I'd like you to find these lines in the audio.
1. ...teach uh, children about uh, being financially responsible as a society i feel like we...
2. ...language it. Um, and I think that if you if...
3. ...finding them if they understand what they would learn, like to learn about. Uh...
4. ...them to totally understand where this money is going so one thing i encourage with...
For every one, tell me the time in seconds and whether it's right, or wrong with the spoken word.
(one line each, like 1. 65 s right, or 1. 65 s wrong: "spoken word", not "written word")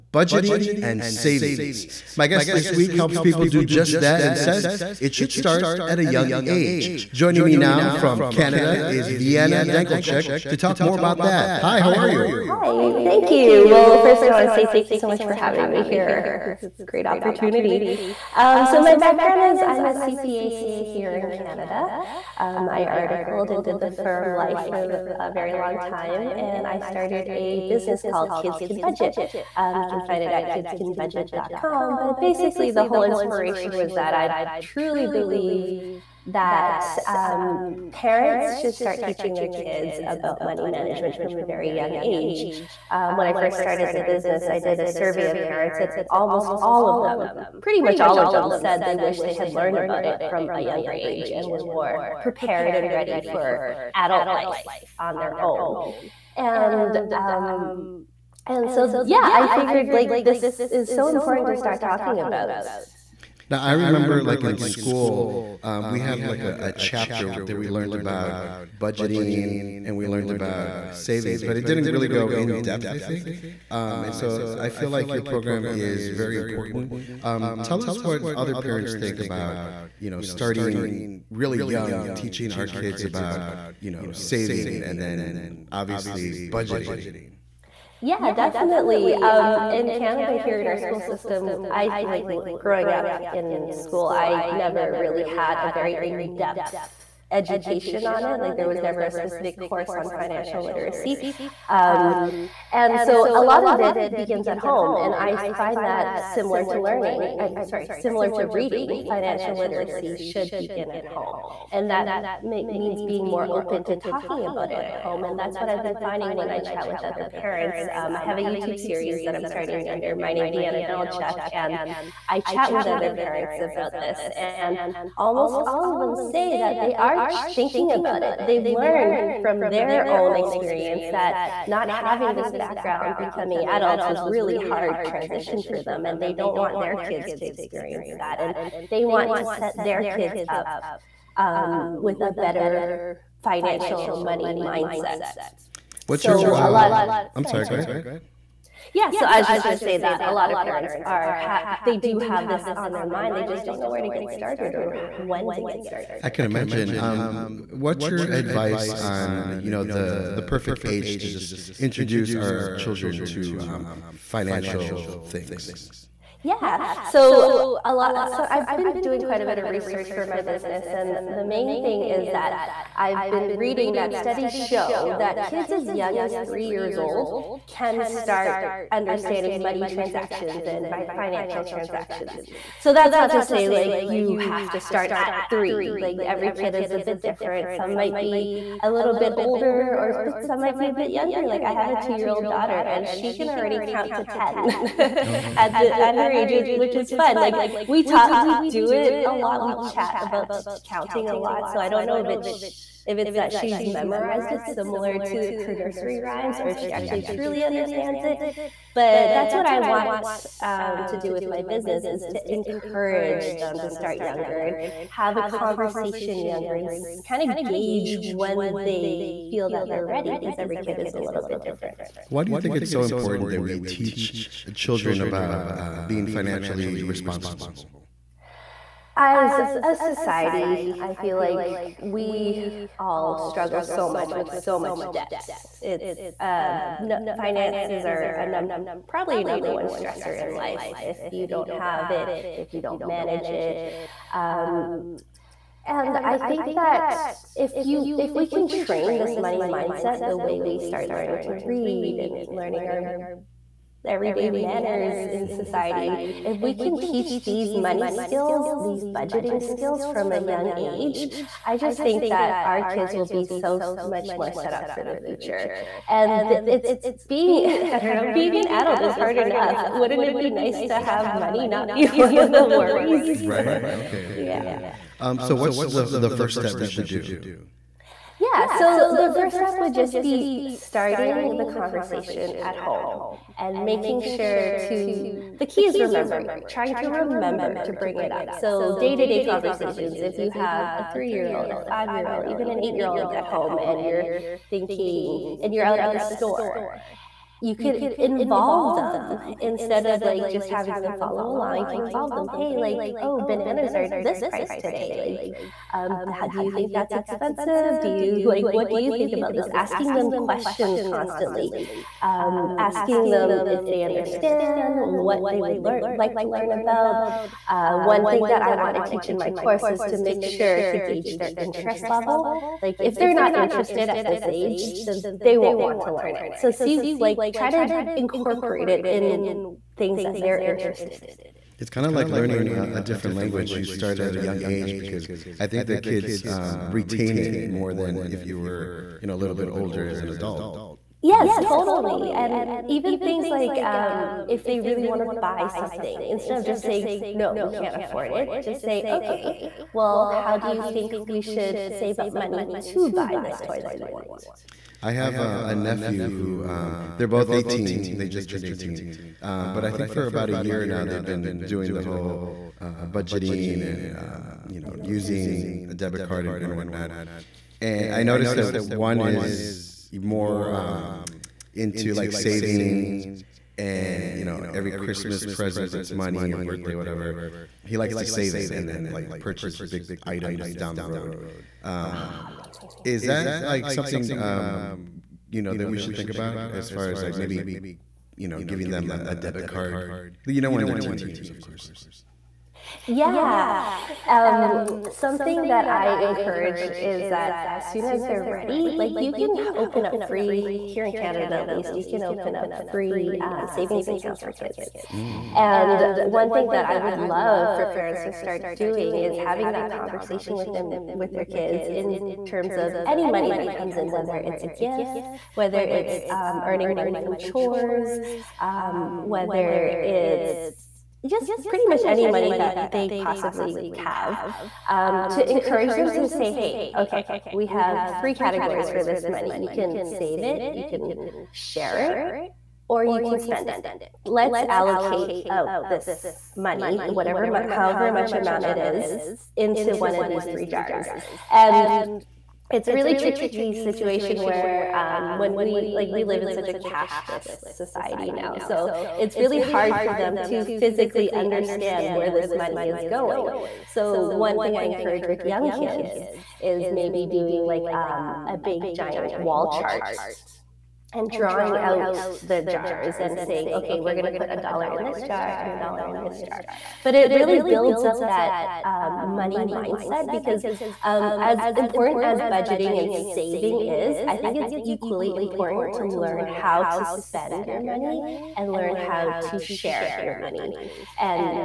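1. 223 s right
2. 243 s wrong: "manage", not "language"
3. 312 s wrong: "asking", not "finding"
4. 450 s wrong: "physically", not "totally".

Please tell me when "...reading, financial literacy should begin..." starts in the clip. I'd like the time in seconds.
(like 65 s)
108 s.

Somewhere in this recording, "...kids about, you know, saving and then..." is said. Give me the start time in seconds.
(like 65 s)
82 s.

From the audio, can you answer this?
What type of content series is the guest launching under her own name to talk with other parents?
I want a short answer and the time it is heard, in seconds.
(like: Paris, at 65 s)
YouTube series, at 118 s.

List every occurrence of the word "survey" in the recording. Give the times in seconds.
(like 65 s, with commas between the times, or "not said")
44 s.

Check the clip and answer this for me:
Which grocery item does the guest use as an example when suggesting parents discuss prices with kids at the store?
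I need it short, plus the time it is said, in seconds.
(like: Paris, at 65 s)
Bananas, at 303 s.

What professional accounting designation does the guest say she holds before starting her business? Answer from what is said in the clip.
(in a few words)
CPA, CA.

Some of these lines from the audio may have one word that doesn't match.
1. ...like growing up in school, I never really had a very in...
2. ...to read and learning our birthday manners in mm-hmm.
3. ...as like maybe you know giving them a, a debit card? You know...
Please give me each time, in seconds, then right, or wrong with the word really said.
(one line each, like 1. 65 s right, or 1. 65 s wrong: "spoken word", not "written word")
1. 92 s right
2. 251 s wrong: "everyday", not "birthday"
3. 387 s right.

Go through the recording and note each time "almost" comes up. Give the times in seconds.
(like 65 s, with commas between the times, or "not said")
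46 s, 125 s.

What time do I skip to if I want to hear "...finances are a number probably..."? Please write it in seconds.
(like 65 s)
237 s.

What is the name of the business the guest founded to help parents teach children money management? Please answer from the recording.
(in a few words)
Kids Can Budget.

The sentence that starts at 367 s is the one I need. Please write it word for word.
And I noticed that one is more um, into like savings and you know every Christmas present that's money or birthday whatever.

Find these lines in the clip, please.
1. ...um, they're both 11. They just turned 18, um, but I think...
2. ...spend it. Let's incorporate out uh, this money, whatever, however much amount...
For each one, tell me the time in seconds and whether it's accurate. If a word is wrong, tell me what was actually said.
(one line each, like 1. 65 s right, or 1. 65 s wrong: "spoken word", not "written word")
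1. 356 s wrong: "18", not "11"
2. 433 s wrong: "allocate", not "incorporate".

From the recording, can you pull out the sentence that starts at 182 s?
So that's not to say like you have to start at three.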